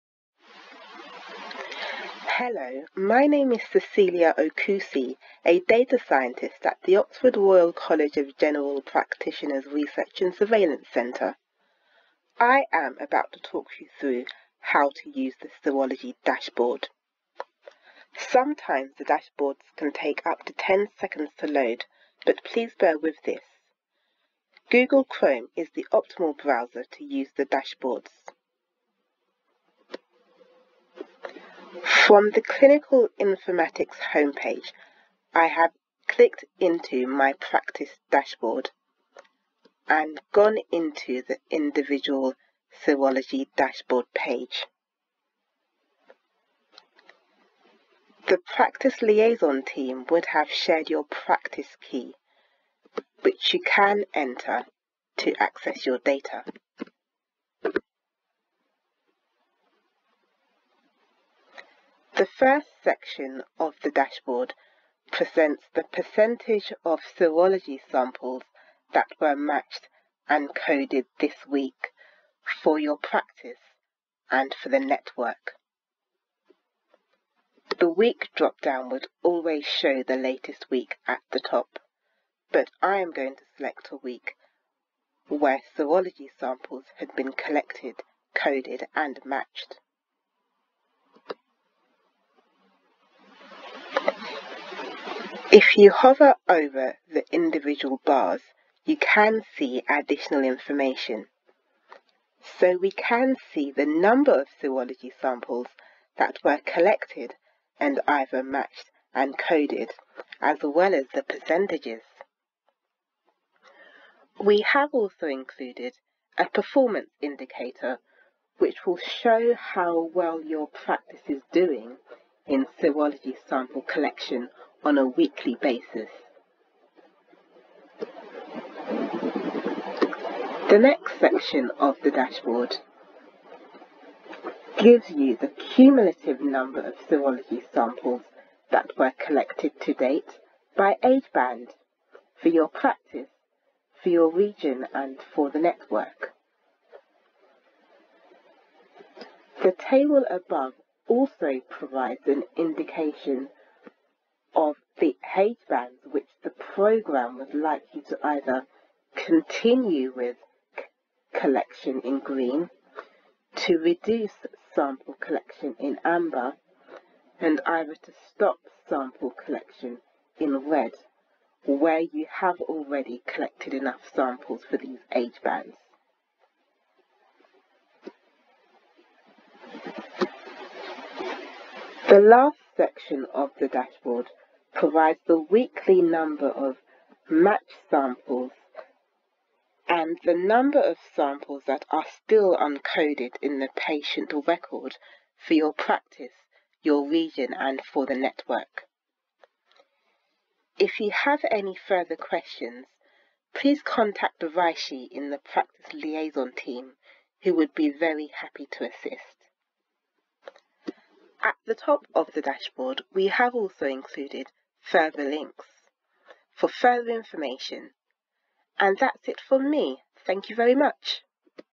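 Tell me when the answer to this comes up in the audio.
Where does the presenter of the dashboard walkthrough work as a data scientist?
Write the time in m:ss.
0:09.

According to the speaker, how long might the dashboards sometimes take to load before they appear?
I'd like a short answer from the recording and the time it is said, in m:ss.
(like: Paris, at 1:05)
10 seconds, at 0:20.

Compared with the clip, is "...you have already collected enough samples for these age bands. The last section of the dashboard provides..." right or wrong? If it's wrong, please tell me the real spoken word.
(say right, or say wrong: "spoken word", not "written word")
right.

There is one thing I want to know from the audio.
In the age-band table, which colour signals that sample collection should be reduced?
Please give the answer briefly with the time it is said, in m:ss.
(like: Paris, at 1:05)
amber, at 2:46.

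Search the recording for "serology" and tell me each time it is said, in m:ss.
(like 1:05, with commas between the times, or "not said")
0:15, 0:42, 1:06, 1:25, 1:44, 2:02, 2:17.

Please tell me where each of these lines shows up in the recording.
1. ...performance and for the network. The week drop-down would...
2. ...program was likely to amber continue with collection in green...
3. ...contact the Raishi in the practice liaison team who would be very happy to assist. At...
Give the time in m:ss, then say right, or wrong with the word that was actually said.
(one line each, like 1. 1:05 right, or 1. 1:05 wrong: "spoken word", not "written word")
1. 1:12 wrong: "practice", not "performance"
2. 2:36 wrong: "either", not "amber"
3. 3:23 right.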